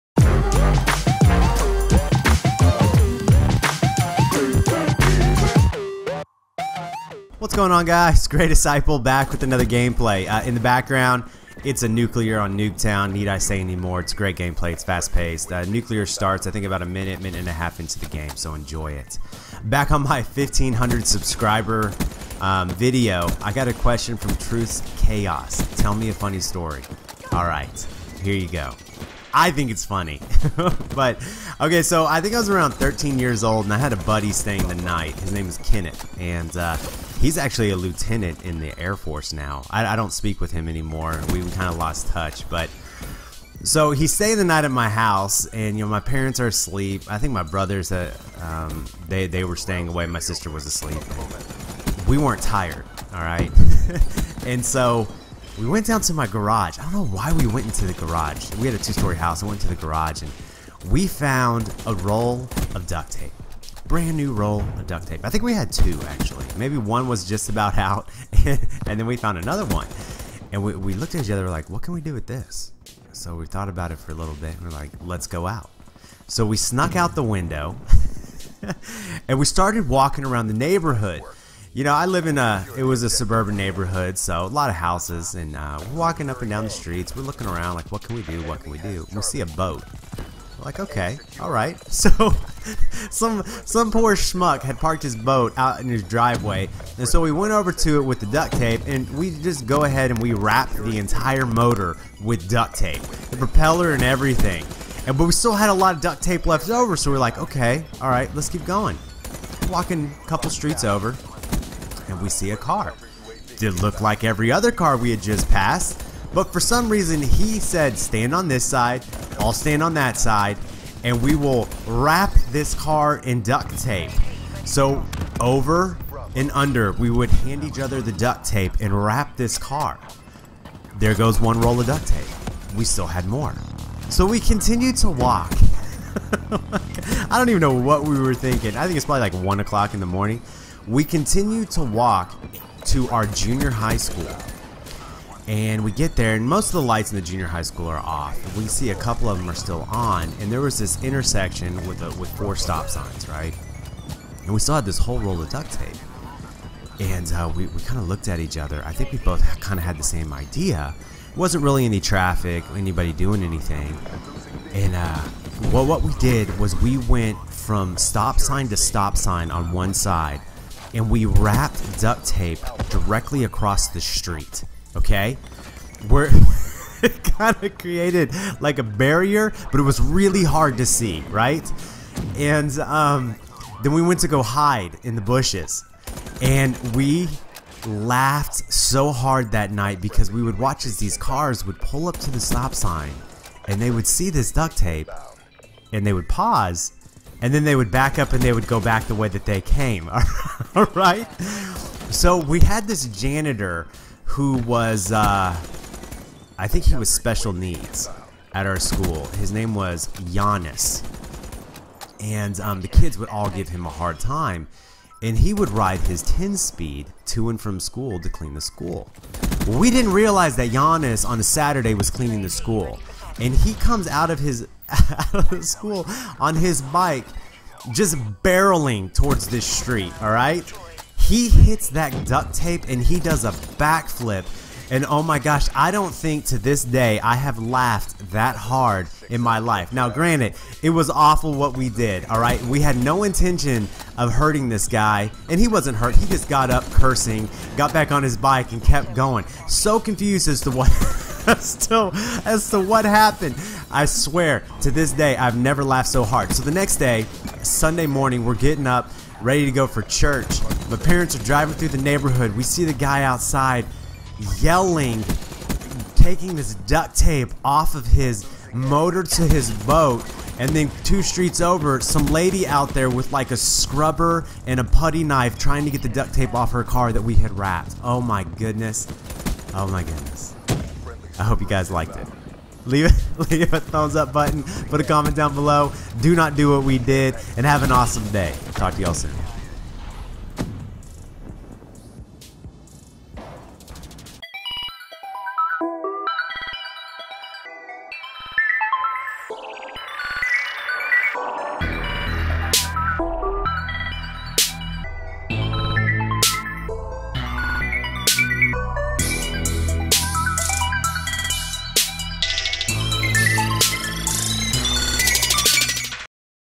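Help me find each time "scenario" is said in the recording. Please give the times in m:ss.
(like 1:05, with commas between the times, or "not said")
not said.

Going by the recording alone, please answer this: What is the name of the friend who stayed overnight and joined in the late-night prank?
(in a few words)
Kenneth.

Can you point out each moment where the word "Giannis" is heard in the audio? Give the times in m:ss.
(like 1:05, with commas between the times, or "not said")
3:30, 3:40.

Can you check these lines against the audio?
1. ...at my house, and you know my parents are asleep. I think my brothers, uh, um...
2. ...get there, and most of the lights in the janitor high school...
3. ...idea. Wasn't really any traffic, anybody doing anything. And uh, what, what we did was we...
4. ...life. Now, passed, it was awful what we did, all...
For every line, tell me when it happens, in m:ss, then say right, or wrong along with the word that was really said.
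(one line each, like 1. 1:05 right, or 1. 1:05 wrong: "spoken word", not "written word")
1. 0:44 right
2. 2:25 wrong: "junior", not "janitor"
3. 2:40 right
4. 3:59 wrong: "granted", not "passed".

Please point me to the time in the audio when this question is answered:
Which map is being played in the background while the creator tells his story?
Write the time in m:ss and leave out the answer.
0:12.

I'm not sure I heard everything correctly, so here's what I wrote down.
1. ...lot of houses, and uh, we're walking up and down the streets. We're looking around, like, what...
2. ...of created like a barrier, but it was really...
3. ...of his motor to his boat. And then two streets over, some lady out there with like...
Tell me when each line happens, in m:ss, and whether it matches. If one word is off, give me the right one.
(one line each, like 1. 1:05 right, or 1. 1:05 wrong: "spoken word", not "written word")
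1. 1:24 right
2. 2:57 right
3. 4:27 right.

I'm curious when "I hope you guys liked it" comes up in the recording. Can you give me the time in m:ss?
4:41.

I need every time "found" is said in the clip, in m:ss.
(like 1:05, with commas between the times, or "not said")
1:01, 1:09.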